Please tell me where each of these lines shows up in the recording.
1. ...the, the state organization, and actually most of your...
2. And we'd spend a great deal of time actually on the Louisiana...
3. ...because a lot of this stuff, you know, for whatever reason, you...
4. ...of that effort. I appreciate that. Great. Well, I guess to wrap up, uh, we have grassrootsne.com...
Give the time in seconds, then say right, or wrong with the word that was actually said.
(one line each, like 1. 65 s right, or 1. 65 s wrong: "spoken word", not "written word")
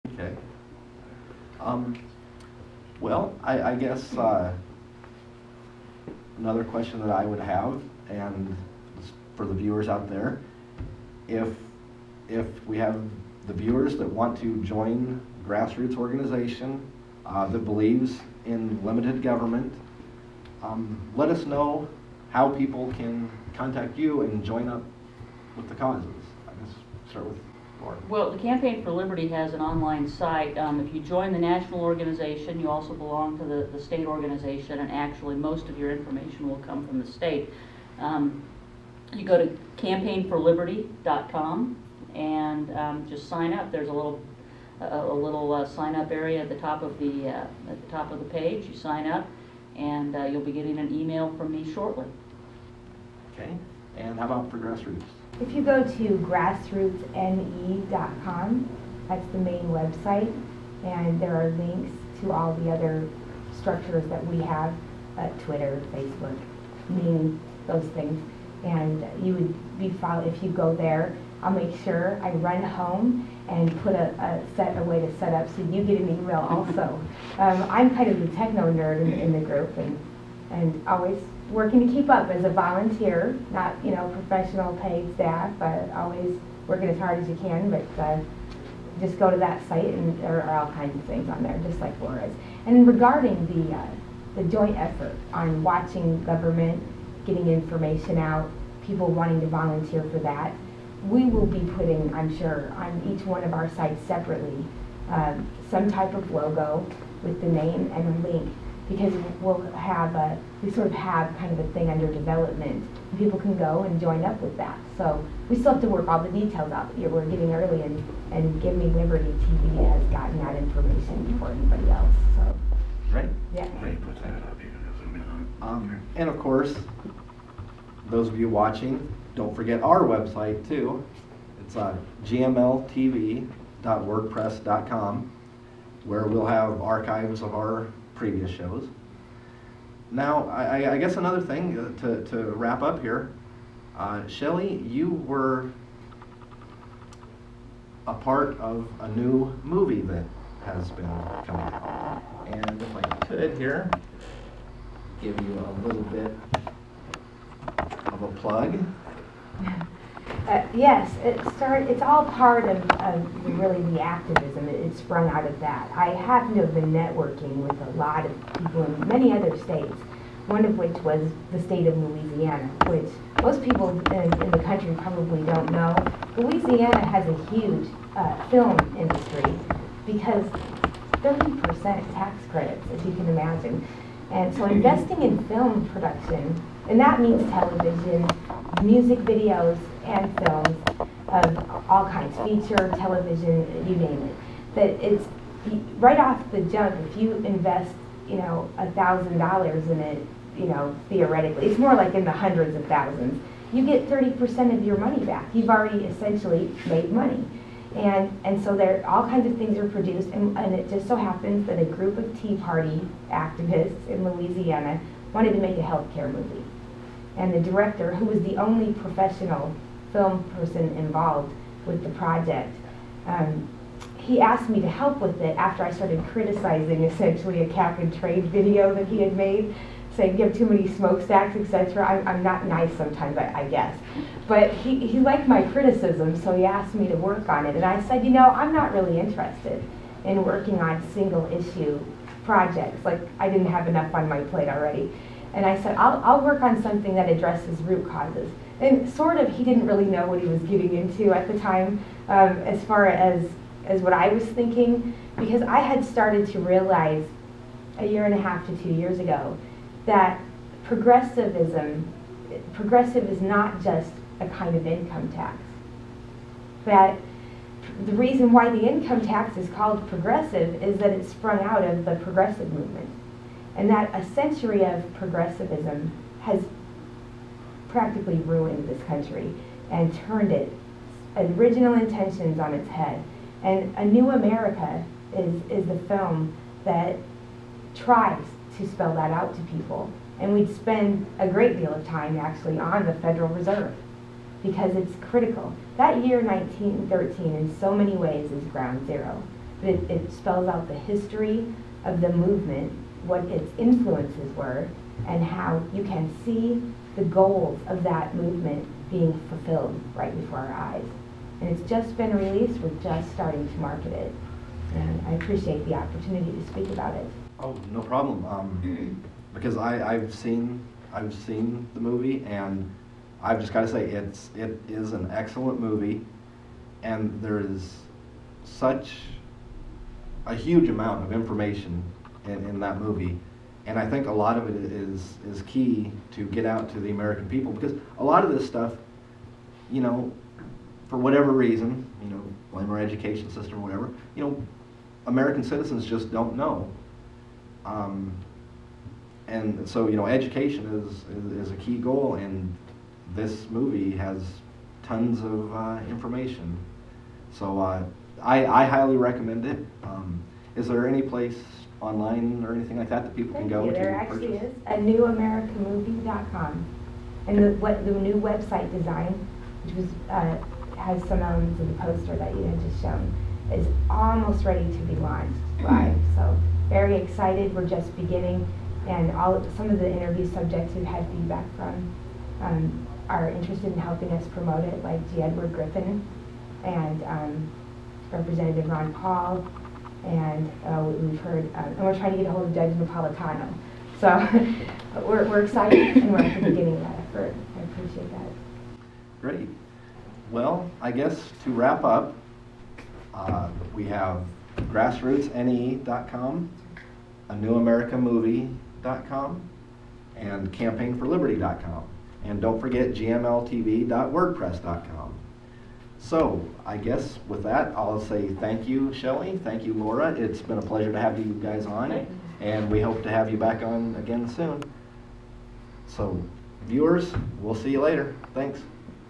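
1. 33 s right
2. 290 s wrong: "Federal", not "Louisiana"
3. 337 s right
4. 396 s right.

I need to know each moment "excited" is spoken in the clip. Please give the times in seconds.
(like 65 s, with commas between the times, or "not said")
377 s, 395 s.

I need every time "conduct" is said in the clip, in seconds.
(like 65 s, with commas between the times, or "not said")
not said.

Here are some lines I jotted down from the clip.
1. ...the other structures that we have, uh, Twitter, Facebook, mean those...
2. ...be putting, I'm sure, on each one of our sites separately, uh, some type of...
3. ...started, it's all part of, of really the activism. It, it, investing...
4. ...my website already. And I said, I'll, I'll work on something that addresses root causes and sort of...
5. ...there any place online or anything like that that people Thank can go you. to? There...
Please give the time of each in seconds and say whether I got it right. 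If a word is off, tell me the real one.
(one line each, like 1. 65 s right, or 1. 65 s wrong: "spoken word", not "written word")
1. 62 s right
2. 101 s right
3. 161 s wrong: "sprung", not "investing"
4. 244 s wrong: "plate", not "website"
5. 360 s right.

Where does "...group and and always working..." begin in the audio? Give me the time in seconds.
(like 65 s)
79 s.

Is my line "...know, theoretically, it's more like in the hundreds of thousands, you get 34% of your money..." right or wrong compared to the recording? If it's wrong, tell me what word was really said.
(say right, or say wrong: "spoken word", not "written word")
wrong: "30", not "34".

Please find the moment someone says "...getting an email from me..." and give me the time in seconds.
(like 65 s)
50 s.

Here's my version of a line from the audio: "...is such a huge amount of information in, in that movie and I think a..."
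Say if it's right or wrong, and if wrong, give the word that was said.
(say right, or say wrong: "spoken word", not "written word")
right.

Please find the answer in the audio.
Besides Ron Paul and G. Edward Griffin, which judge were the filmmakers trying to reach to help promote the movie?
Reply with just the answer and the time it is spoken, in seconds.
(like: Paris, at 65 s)
Judge Napolitano, at 392 s.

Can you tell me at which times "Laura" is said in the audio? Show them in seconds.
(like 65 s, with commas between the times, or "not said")
92 s, 419 s.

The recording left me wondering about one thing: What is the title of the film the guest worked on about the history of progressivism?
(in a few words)
A New America.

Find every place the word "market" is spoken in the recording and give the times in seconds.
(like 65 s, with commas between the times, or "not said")
313 s.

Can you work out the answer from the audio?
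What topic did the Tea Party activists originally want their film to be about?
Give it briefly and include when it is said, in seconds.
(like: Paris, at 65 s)
Healthcare, at 215 s.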